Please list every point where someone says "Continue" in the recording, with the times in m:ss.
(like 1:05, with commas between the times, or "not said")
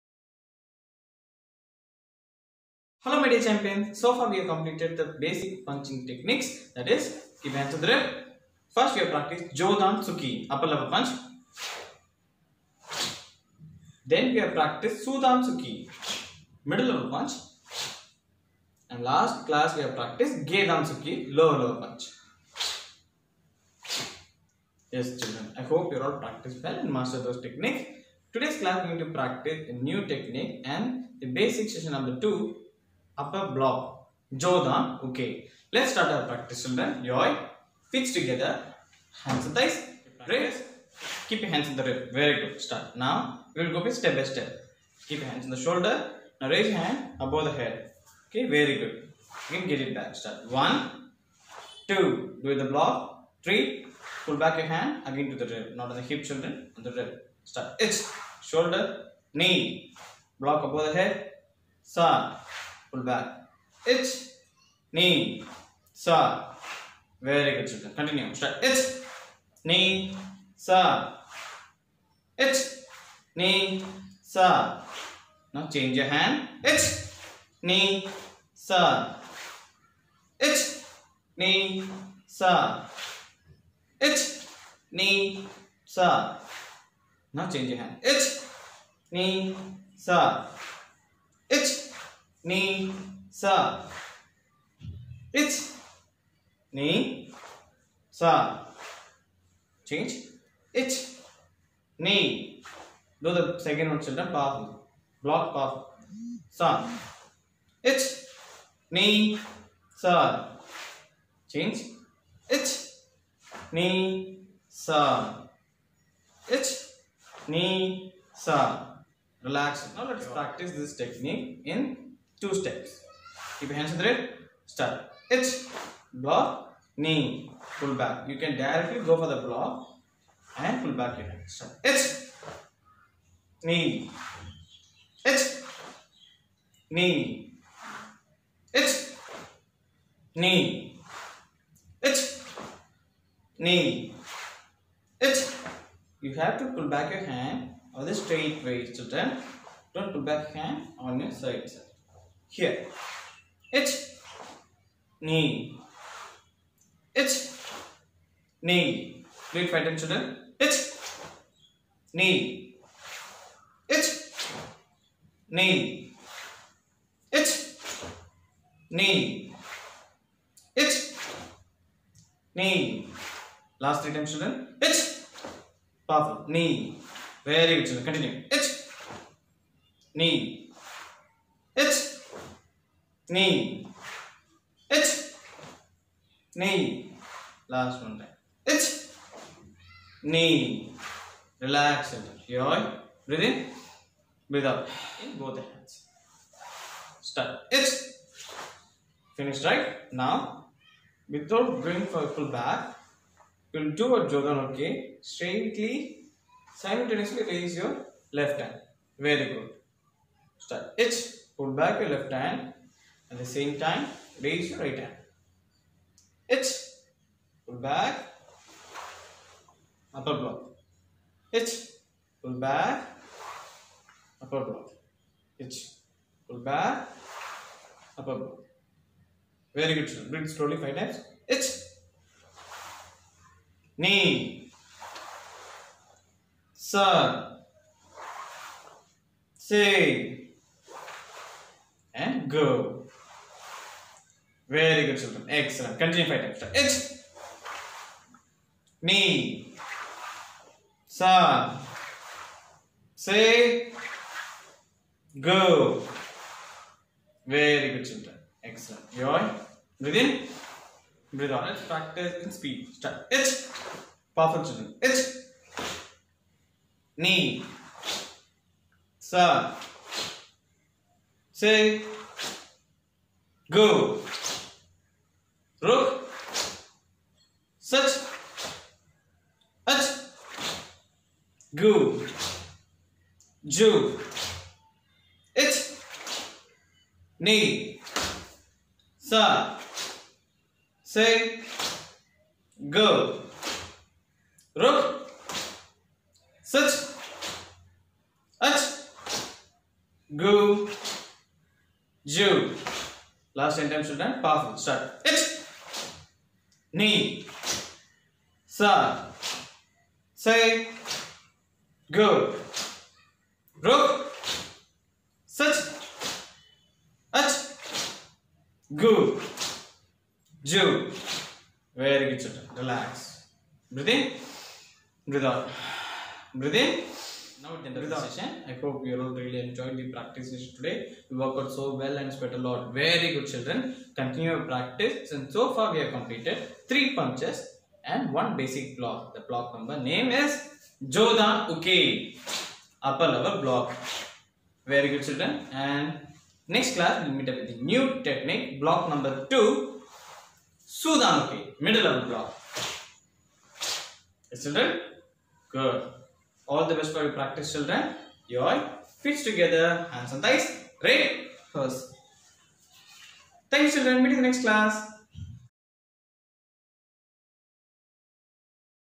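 1:07, 2:58, 4:05, 5:34.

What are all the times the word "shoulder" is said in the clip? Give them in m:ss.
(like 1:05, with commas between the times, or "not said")
0:45, 0:58.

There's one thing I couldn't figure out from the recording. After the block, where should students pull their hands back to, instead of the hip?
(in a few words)
on the rib.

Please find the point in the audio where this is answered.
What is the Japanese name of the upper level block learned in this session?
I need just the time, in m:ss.
5:41.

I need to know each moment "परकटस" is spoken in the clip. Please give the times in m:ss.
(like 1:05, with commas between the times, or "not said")
2:00.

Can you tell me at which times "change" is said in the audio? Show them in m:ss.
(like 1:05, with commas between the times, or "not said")
1:15, 1:27.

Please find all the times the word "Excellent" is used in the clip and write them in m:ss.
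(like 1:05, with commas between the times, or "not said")
4:05, 4:18.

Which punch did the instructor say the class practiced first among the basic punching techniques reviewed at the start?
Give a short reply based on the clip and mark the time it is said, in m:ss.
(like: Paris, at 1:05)
Jodan Tsuki, at 0:09.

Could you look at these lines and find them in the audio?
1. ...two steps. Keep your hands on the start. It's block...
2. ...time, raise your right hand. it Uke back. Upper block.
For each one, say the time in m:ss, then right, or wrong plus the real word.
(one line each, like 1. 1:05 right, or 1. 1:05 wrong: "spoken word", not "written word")
1. 2:02 right
2. 3:33 wrong: "Pull", not "Uke".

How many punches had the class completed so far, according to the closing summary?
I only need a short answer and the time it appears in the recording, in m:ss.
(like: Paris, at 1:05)
3, at 5:36.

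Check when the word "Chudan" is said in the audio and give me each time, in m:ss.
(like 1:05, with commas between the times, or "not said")
0:15, 5:50.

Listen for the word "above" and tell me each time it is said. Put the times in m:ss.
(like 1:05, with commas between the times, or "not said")
0:47, 1:00.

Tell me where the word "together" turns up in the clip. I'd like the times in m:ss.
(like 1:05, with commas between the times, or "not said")
0:38, 5:59.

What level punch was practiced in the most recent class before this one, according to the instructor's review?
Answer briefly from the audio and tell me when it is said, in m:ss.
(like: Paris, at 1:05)
Gedan Tsuki, at 0:20.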